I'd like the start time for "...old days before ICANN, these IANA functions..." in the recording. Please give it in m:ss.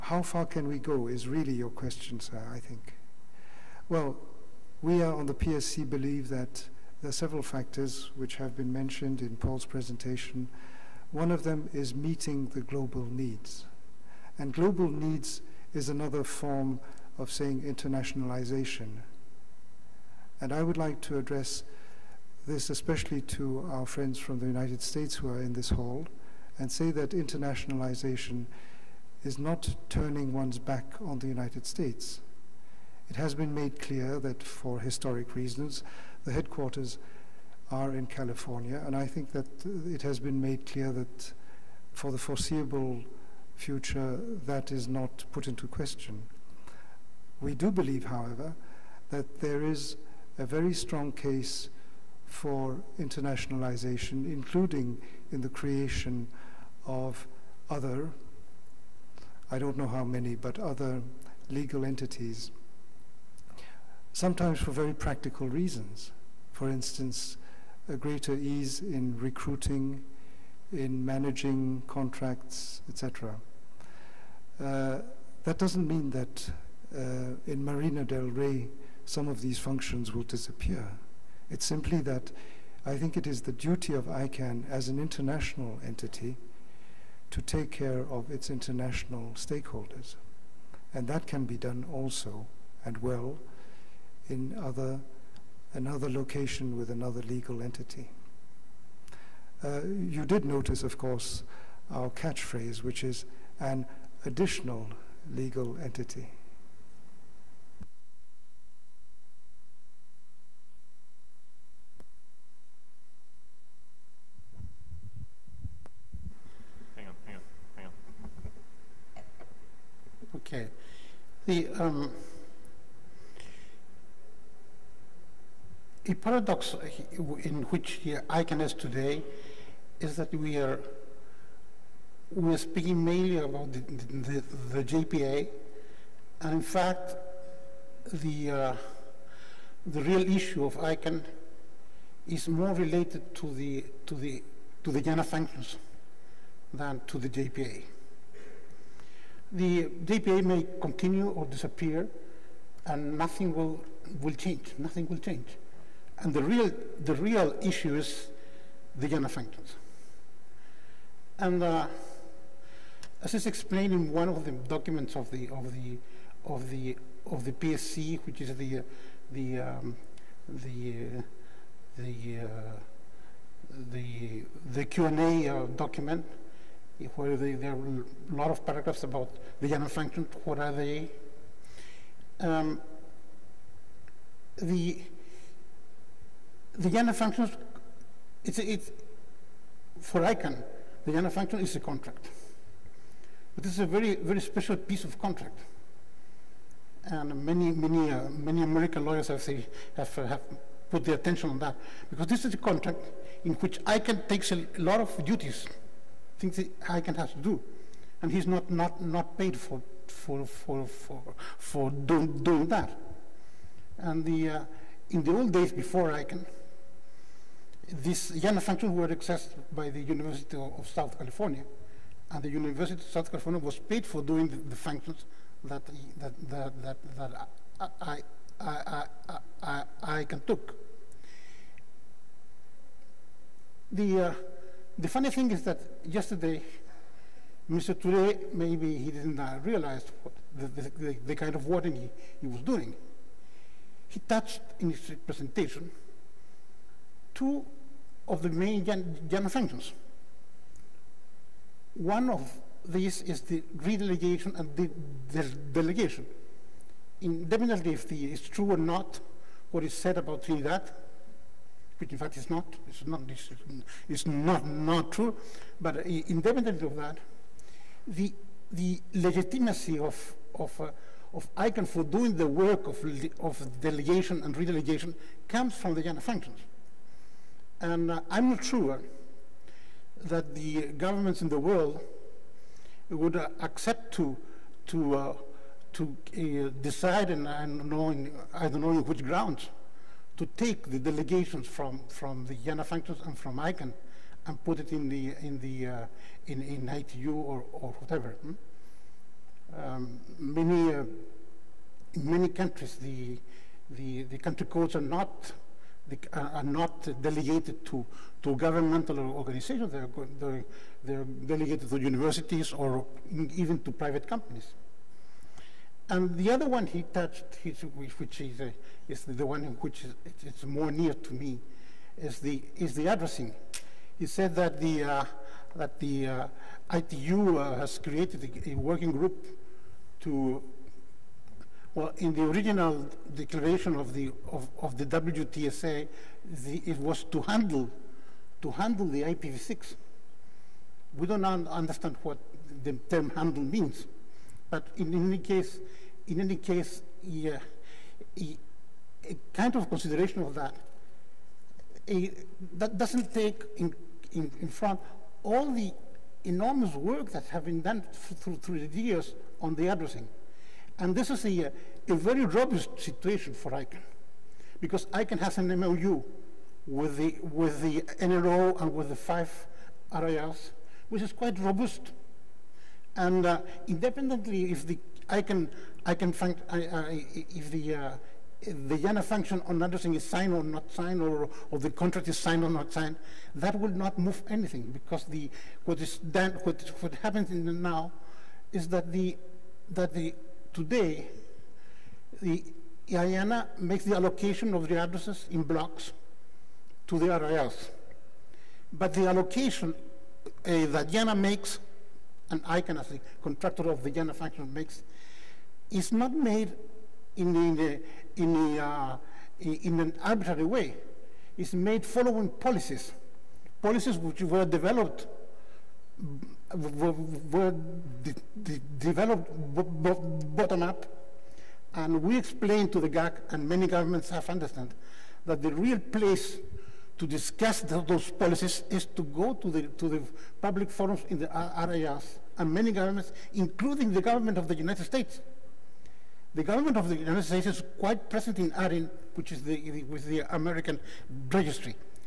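3:35.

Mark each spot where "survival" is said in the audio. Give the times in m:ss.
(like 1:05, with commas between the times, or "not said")
not said.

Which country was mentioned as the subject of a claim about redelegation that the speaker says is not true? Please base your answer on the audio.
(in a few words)
Trinidad.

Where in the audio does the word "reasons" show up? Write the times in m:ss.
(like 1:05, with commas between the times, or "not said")
0:35, 1:05.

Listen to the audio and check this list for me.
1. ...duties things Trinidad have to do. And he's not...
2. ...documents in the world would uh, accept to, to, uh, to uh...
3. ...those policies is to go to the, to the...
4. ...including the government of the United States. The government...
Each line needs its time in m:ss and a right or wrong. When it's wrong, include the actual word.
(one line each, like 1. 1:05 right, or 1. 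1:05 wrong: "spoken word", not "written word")
1. 3:25 wrong: "ICANN", not "Trinidad"
2. 4:40 wrong: "governments", not "documents"
3. 7:08 right
4. 7:13 right.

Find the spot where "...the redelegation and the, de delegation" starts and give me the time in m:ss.
4:13.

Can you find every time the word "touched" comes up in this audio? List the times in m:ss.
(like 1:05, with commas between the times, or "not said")
4:04, 5:17.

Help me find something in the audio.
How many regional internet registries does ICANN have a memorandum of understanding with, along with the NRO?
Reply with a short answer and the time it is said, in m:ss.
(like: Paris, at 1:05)
5, at 6:09.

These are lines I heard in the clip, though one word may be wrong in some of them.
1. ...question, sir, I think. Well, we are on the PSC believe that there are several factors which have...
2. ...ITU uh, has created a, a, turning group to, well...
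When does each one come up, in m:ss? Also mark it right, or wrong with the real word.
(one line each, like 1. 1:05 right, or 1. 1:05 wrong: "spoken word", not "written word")
1. 0:01 right
2. 5:26 wrong: "working", not "turning".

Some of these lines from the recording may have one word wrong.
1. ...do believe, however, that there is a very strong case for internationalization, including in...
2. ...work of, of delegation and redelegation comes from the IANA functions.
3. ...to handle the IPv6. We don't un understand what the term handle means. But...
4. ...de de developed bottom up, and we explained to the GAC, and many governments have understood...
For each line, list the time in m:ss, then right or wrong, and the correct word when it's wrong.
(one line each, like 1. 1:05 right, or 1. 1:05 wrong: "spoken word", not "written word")
1. 0:47 right
2. 4:32 right
3. 5:38 right
4. 6:58 right.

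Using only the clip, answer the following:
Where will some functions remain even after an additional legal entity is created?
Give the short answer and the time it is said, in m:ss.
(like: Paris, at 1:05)
Marina del Rey, at 1:17.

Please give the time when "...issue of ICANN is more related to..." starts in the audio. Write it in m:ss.
2:20.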